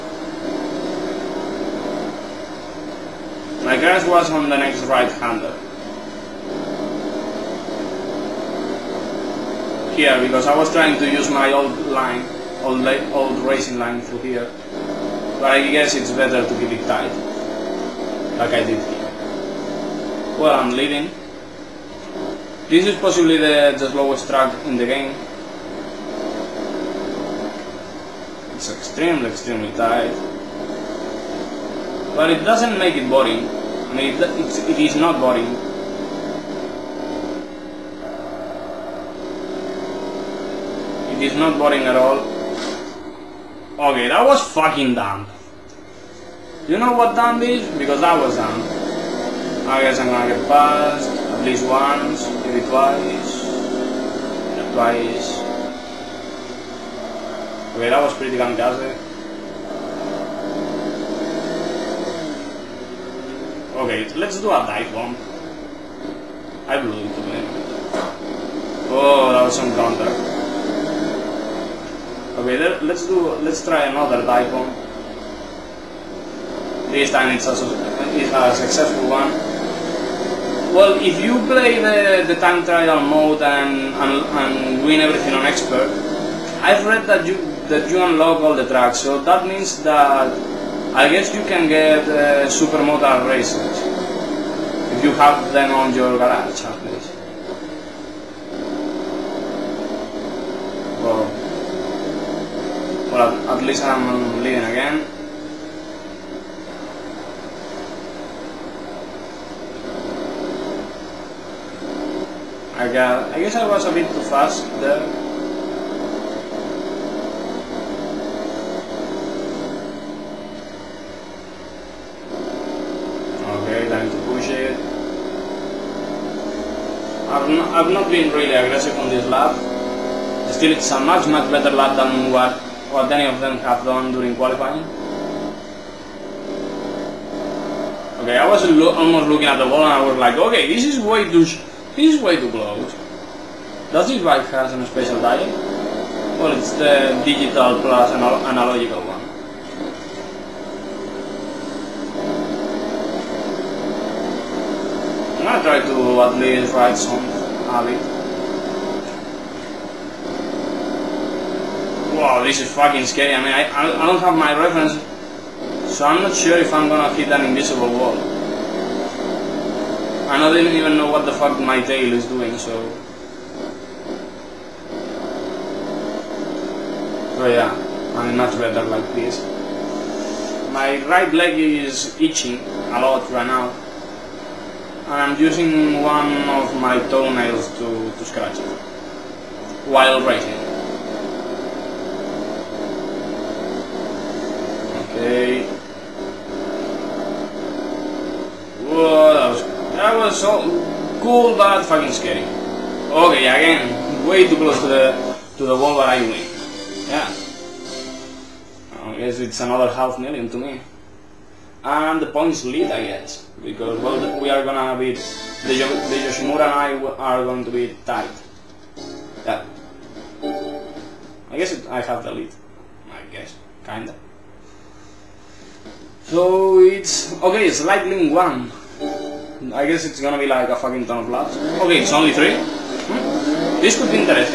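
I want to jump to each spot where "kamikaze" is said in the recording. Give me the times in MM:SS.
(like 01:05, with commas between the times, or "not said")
00:58.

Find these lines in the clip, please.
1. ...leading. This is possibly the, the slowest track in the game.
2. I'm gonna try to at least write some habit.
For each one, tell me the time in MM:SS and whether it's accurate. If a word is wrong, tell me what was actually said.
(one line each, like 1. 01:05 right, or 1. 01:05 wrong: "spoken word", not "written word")
1. 00:20 right
2. 02:35 right.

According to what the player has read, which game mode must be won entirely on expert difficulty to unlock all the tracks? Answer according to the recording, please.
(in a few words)
Time trial.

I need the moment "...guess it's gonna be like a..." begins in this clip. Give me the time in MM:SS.
03:49.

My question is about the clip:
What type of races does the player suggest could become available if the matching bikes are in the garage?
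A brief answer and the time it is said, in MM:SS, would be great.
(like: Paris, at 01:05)
Supermoto, at 01:32.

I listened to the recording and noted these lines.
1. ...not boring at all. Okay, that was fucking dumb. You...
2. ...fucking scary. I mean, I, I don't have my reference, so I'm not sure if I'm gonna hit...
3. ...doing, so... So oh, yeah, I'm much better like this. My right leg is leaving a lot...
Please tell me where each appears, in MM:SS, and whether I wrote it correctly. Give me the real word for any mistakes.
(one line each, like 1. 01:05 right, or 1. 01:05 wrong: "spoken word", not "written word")
1. 00:41 right
2. 02:42 right
3. 02:52 wrong: "itching", not "leaving".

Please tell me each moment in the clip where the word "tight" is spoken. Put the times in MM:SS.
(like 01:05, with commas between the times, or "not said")
00:16, 00:29.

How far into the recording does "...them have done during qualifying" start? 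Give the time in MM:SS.
02:13.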